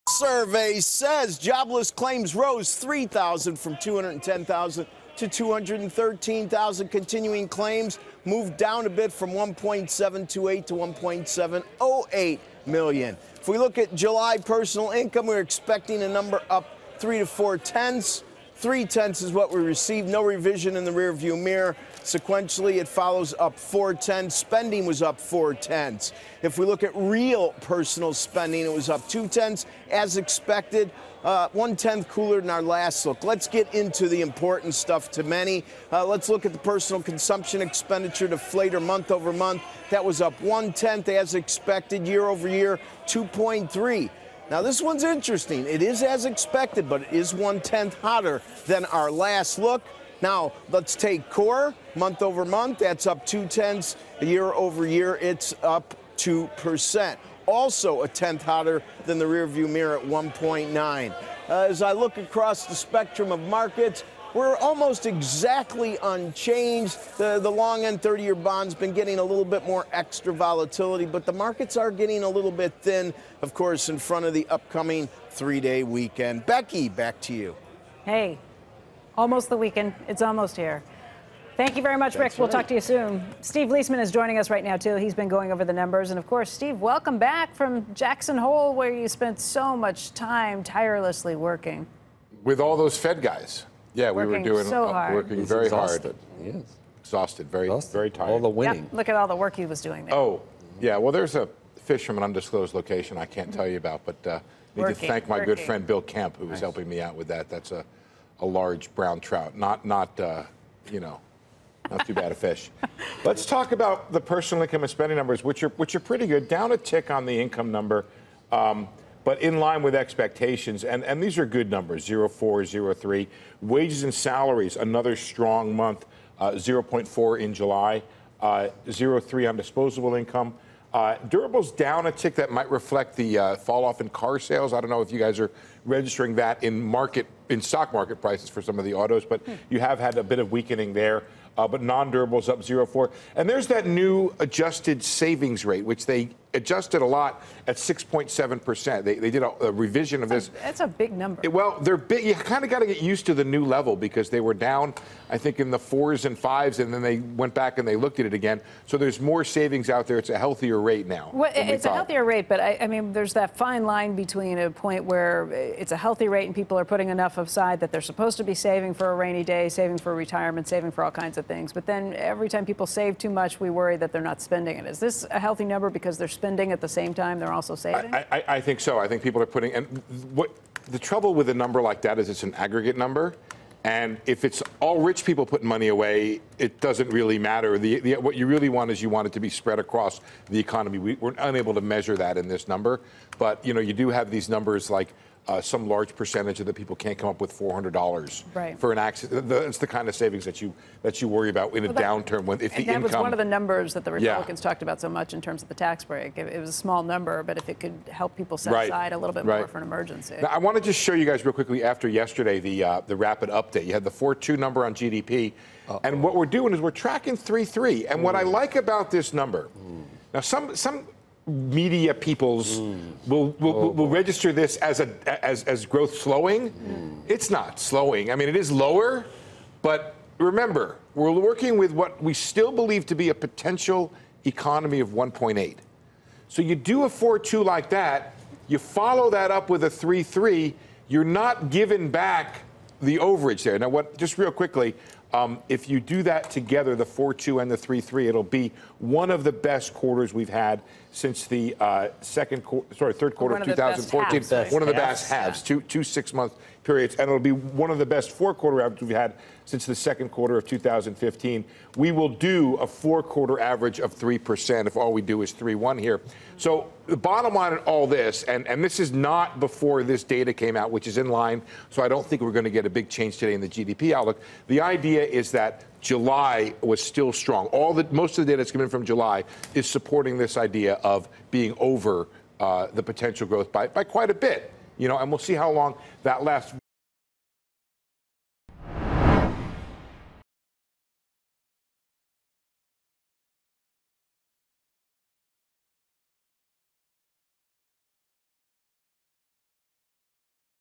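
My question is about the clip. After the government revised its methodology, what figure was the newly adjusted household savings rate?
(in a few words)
6.7%.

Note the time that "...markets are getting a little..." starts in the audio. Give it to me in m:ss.
1:11.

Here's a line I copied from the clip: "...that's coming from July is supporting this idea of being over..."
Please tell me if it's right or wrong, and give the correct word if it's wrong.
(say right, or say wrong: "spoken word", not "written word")
right.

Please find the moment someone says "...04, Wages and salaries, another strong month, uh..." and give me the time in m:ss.
2:02.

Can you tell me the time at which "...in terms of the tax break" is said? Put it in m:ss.
3:25.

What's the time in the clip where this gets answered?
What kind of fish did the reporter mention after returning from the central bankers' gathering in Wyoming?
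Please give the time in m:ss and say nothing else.
1:48.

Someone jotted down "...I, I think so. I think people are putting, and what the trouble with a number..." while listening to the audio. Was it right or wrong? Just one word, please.
right.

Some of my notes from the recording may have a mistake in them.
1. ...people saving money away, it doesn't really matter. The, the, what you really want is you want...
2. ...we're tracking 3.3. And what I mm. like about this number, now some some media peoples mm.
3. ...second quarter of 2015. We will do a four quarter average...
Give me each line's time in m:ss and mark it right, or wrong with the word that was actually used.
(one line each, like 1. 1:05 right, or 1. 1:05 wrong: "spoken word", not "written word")
1. 3:05 wrong: "putting", not "saving"
2. 3:36 right
3. 4:19 right.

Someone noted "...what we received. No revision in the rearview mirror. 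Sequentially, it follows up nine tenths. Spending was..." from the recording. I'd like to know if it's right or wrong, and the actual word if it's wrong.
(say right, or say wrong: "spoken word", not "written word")
wrong: "four", not "nine".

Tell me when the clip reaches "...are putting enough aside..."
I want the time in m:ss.
2:46.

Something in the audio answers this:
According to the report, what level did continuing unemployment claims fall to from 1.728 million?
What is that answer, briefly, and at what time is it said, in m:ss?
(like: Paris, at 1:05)
1.708 million, at 0:10.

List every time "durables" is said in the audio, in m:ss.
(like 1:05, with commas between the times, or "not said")
2:11, 2:21.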